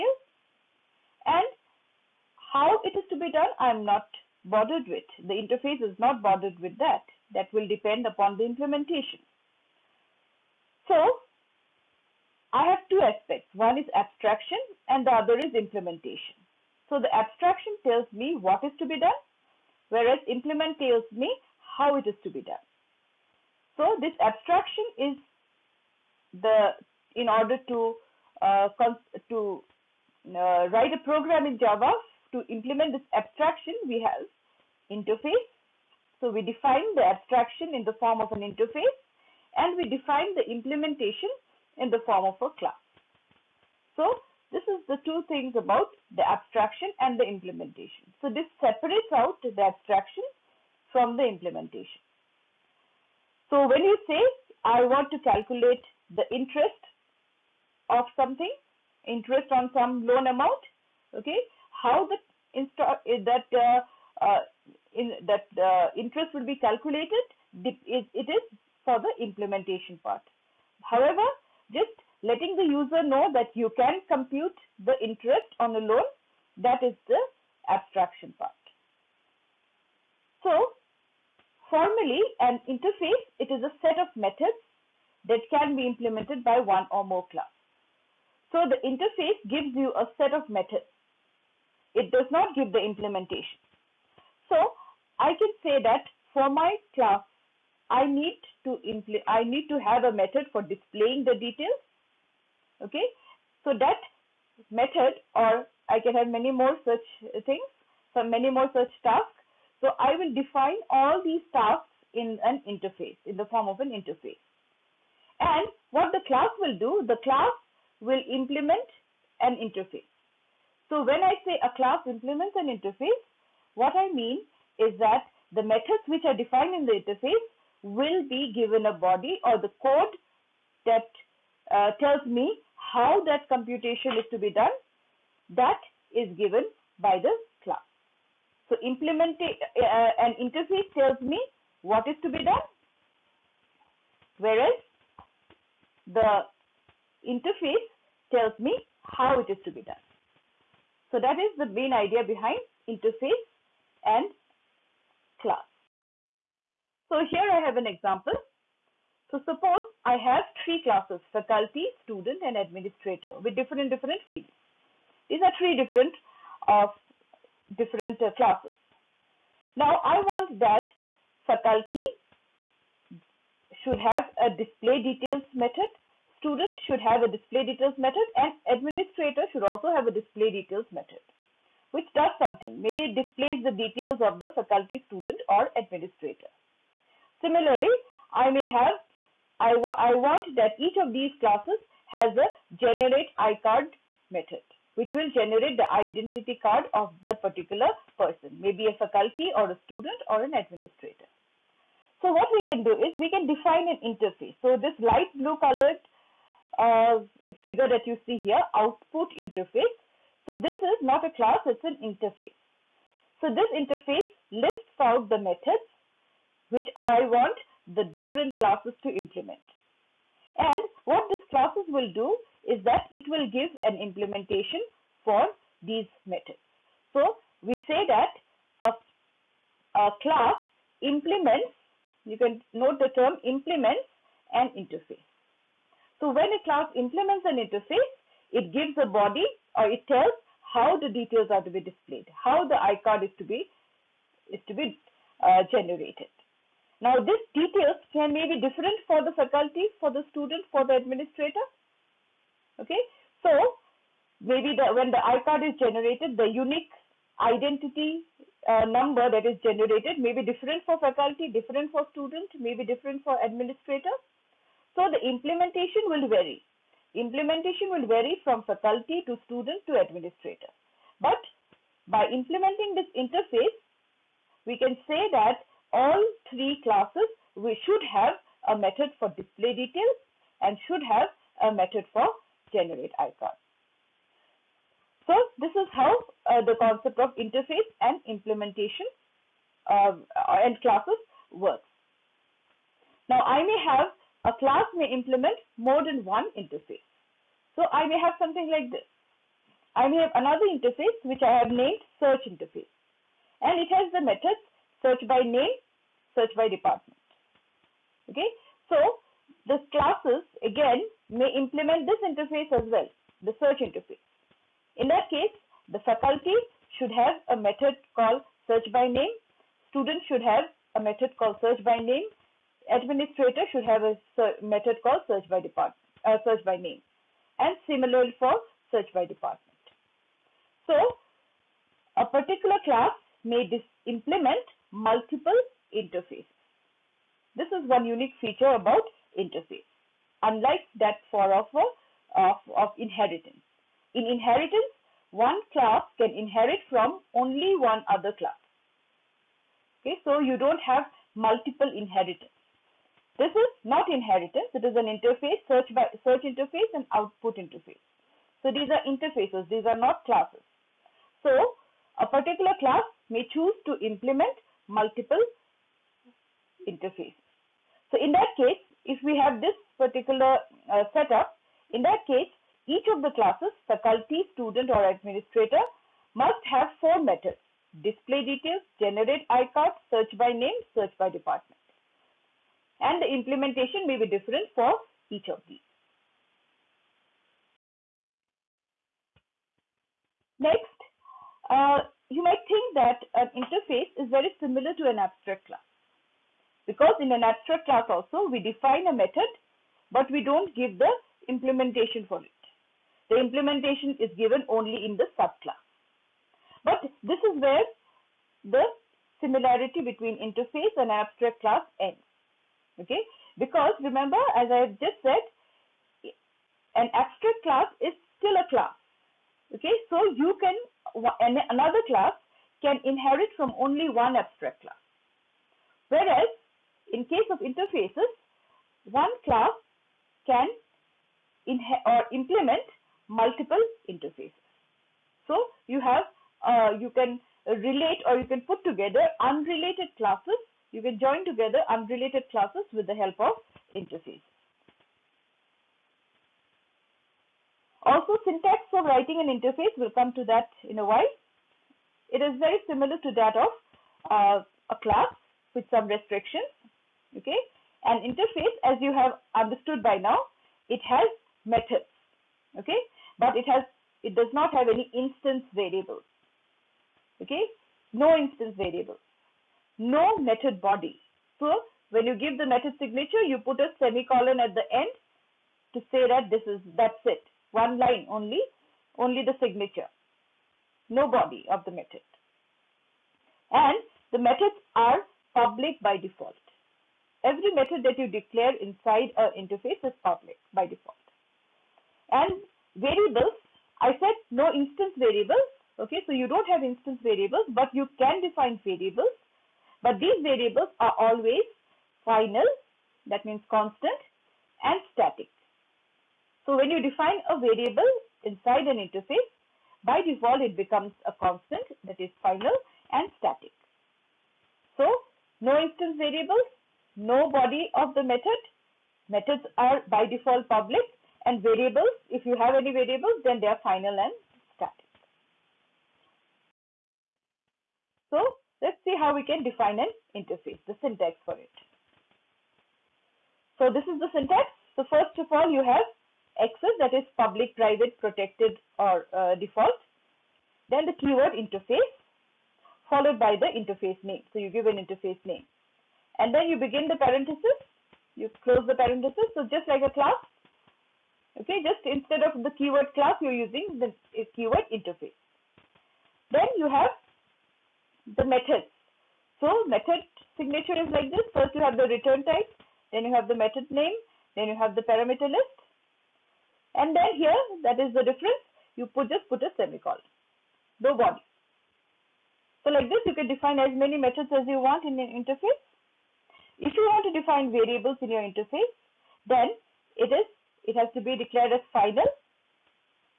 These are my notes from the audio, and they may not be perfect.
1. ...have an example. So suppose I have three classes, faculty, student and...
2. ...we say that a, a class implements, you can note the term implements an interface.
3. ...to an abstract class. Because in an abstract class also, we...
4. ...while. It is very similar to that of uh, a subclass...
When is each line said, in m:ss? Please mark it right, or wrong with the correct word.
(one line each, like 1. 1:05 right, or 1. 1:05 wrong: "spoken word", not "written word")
1. 2:37 right
2. 3:47 right
3. 6:34 right
4. 7:31 wrong: "class", not "subclass".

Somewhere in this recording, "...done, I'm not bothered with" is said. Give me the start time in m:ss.
0:03.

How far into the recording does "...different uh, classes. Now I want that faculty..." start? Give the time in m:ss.
2:47.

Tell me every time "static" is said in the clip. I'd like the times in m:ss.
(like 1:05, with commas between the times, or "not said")
8:25, 8:33, 8:44.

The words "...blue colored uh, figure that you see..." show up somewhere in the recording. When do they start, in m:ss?
3:25.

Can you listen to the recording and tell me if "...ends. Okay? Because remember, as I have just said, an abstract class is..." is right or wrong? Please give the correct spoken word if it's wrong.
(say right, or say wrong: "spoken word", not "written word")
right.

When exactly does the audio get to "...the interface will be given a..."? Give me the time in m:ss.
2:06.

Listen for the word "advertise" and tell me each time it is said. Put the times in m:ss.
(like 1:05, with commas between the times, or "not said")
not said.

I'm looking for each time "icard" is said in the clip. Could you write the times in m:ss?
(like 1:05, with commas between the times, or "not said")
3:13, 4:02, 4:15, 4:43, 6:19.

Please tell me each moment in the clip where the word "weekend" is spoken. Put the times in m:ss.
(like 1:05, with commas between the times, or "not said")
not said.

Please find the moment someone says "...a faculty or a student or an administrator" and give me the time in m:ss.
3:18.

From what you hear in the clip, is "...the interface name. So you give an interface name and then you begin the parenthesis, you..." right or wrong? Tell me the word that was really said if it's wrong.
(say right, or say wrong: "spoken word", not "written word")
right.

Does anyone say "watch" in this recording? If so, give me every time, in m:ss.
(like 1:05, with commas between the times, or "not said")
not said.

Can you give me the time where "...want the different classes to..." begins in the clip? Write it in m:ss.
3:37.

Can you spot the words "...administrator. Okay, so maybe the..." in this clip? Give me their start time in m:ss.
4:10.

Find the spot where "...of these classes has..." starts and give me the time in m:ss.
3:10.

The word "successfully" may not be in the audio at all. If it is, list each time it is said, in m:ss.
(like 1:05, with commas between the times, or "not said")
not said.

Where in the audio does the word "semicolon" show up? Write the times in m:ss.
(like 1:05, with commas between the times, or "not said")
7:53, 9:29.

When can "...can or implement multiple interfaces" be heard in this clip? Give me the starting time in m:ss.
7:10.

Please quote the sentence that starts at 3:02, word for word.
Maybe it displays the details of the faculty, student or administrator.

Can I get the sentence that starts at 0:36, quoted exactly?
So we define the abstraction in the form of an interface and we define the implementation in the form of a class.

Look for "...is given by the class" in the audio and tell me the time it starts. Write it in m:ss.
2:16.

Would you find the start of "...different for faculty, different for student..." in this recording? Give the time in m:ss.
4:20.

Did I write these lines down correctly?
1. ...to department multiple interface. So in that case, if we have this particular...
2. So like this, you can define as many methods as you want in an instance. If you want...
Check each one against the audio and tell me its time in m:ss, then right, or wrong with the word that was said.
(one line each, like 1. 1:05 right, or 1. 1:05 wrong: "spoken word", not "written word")
1. 6:03 wrong: "implement", not "department"
2. 9:32 wrong: "interface", not "instance".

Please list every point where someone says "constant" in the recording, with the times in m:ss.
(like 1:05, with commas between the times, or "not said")
8:23, 8:31.